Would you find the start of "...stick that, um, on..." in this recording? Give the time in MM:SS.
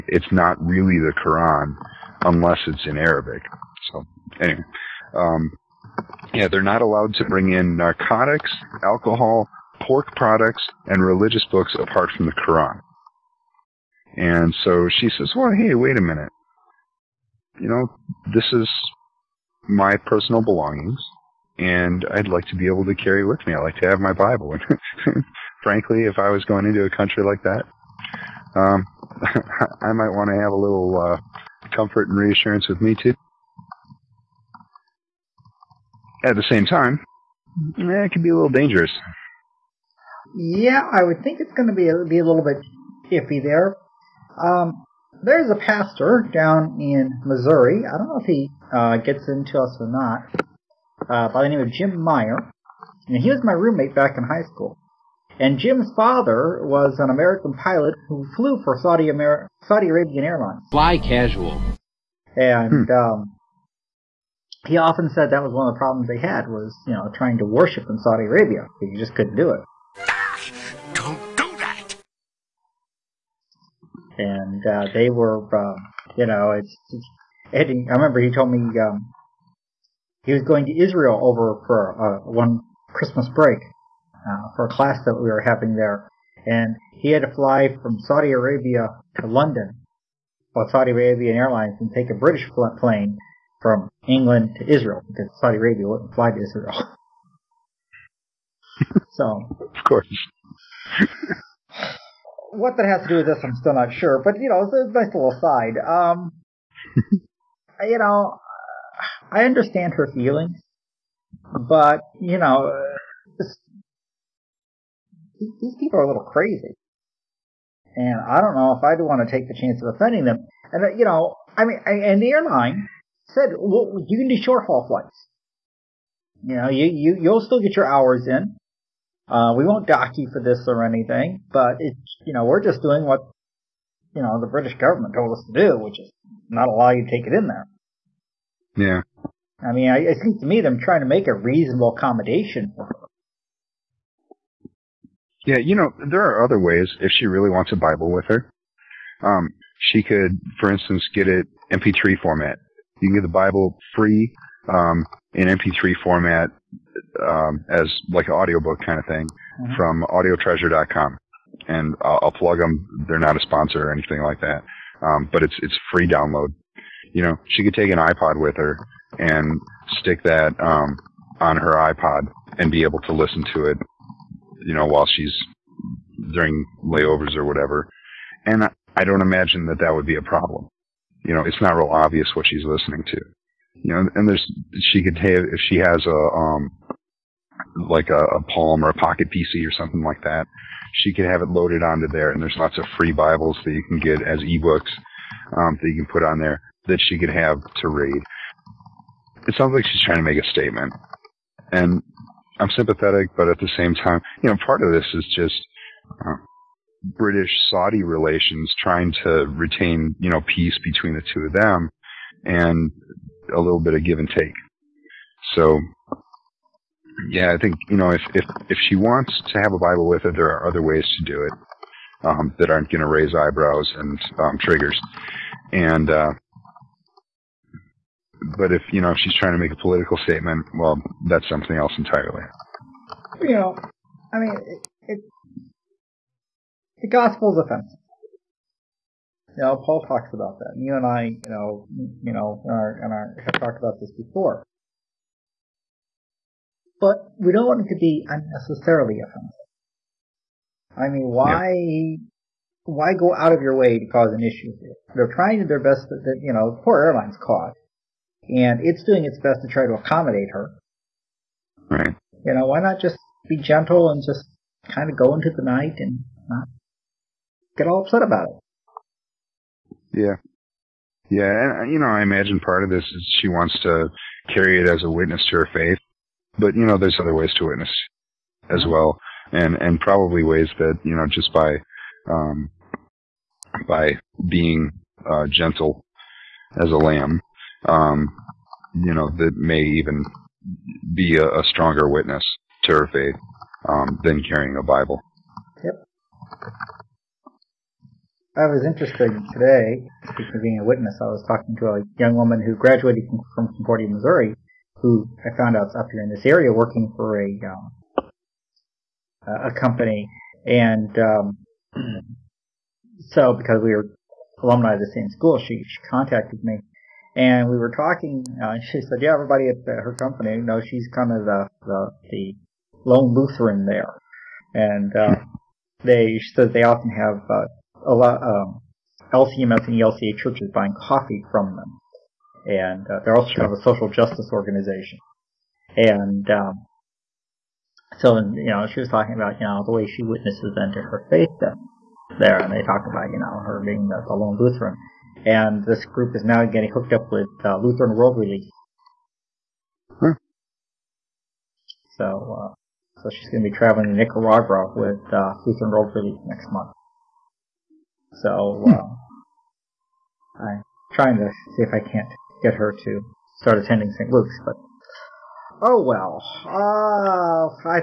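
02:49.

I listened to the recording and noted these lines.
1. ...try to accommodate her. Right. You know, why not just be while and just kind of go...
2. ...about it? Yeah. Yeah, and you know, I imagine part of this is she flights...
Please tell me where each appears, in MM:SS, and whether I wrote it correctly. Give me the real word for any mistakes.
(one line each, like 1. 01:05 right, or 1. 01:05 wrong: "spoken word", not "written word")
1. 04:19 wrong: "gentle", not "while"
2. 04:28 wrong: "wants", not "flights".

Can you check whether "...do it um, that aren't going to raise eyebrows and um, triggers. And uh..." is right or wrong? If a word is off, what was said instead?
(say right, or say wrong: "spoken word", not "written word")
right.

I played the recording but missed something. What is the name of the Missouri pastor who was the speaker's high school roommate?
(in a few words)
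Jim Meyer.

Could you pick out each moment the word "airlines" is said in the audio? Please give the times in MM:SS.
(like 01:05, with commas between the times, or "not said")
01:00, 01:31, 02:02, 04:17.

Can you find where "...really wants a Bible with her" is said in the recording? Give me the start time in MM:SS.
02:27.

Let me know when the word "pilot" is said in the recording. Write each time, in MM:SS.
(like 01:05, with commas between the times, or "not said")
00:57.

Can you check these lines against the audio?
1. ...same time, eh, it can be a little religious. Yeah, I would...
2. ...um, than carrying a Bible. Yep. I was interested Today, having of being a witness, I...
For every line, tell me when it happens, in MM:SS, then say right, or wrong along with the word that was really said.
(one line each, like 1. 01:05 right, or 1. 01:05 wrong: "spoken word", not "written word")
1. 00:36 wrong: "dangerous", not "religious"
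2. 04:53 wrong: "speaking", not "having".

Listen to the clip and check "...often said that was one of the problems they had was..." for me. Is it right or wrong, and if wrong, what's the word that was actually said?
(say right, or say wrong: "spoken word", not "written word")
right.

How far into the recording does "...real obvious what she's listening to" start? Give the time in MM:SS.
03:01.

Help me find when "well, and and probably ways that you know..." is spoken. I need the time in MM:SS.
04:38.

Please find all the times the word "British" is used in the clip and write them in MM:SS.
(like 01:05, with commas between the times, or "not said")
01:32, 02:14, 03:27.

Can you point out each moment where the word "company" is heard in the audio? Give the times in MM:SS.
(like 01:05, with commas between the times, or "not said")
05:09, 05:20.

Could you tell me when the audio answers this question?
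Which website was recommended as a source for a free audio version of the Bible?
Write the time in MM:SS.
02:40.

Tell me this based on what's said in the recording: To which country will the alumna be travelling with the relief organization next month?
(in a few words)
Nicaragua.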